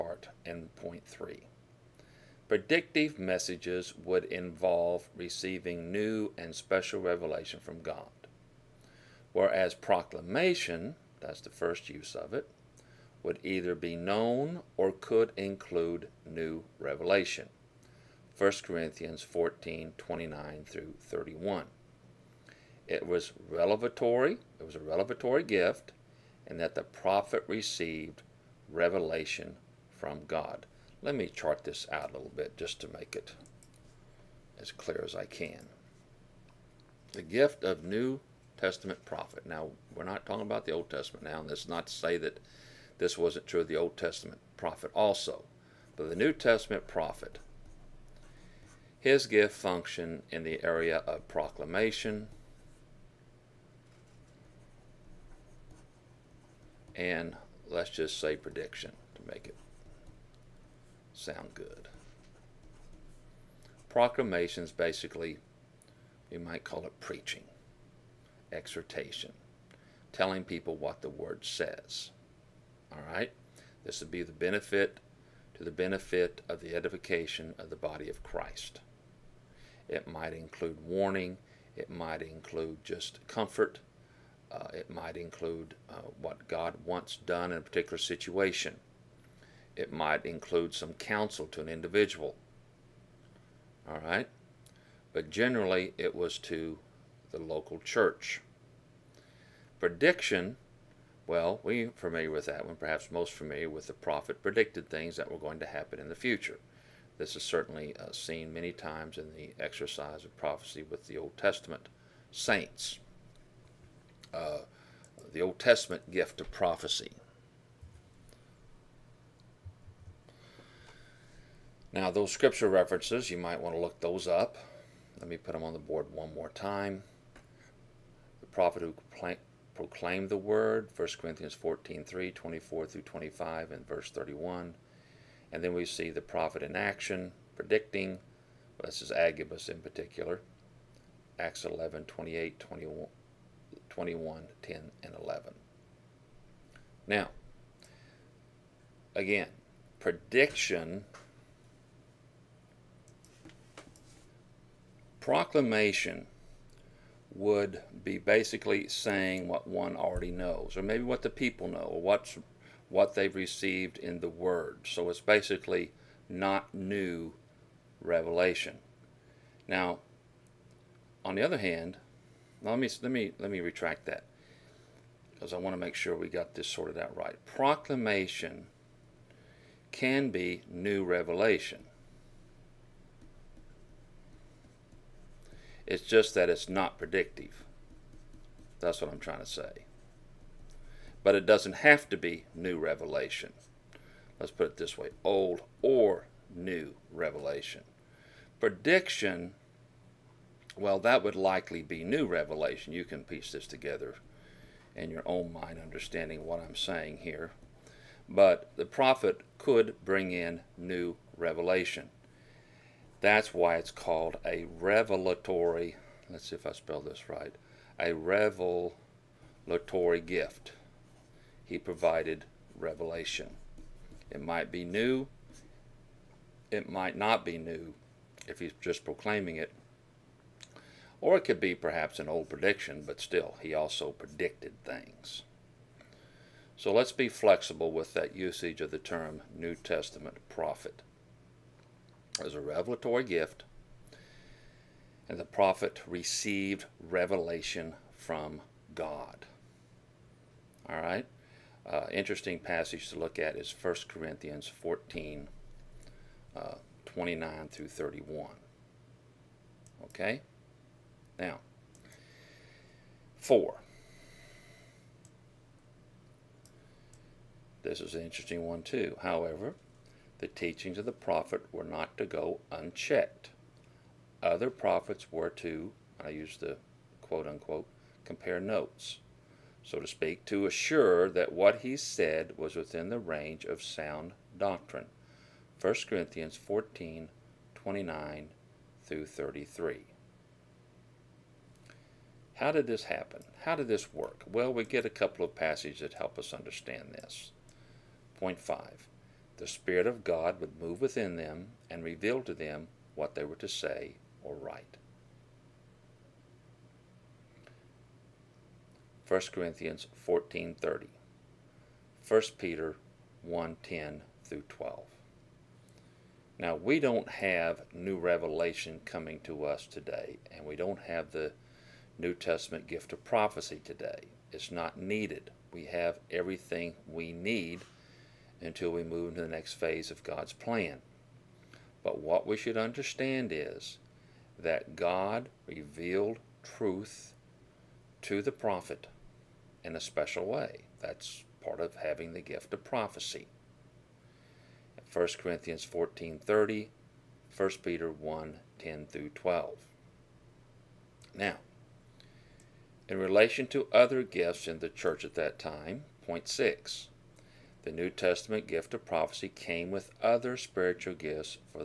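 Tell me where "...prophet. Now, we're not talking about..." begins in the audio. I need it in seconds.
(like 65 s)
39 s.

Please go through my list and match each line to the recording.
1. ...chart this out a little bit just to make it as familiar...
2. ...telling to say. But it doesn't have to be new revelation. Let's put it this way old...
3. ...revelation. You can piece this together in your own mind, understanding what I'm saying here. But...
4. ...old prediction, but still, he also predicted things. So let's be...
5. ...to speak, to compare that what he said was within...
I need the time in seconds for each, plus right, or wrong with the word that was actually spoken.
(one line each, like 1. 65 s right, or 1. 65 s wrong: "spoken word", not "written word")
1. 31 s wrong: "clear", not "familiar"
2. 189 s wrong: "trying", not "telling"
3. 202 s right
4. 232 s right
5. 279 s wrong: "assure", not "compare".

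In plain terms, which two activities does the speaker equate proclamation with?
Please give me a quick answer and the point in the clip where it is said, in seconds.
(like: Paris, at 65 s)
preaching exhortation, at 66 s.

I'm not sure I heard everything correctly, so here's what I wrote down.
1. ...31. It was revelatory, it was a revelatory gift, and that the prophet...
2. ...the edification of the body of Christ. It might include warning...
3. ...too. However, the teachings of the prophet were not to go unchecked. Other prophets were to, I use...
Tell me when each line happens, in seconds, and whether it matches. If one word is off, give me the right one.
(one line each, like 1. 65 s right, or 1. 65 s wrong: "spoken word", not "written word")
1. 21 s right
2. 76 s right
3. 268 s right.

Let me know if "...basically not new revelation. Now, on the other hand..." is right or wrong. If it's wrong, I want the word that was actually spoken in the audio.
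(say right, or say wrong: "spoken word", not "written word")
right.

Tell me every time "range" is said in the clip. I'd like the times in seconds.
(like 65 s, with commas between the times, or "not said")
283 s.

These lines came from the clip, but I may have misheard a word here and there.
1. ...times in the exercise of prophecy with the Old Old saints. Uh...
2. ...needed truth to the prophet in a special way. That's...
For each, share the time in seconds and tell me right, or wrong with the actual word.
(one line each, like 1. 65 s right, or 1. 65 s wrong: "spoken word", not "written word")
1. 108 s wrong: "Testament", not "Old"
2. 335 s wrong: "revealed", not "needed".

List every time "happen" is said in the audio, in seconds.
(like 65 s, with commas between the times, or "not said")
105 s, 293 s.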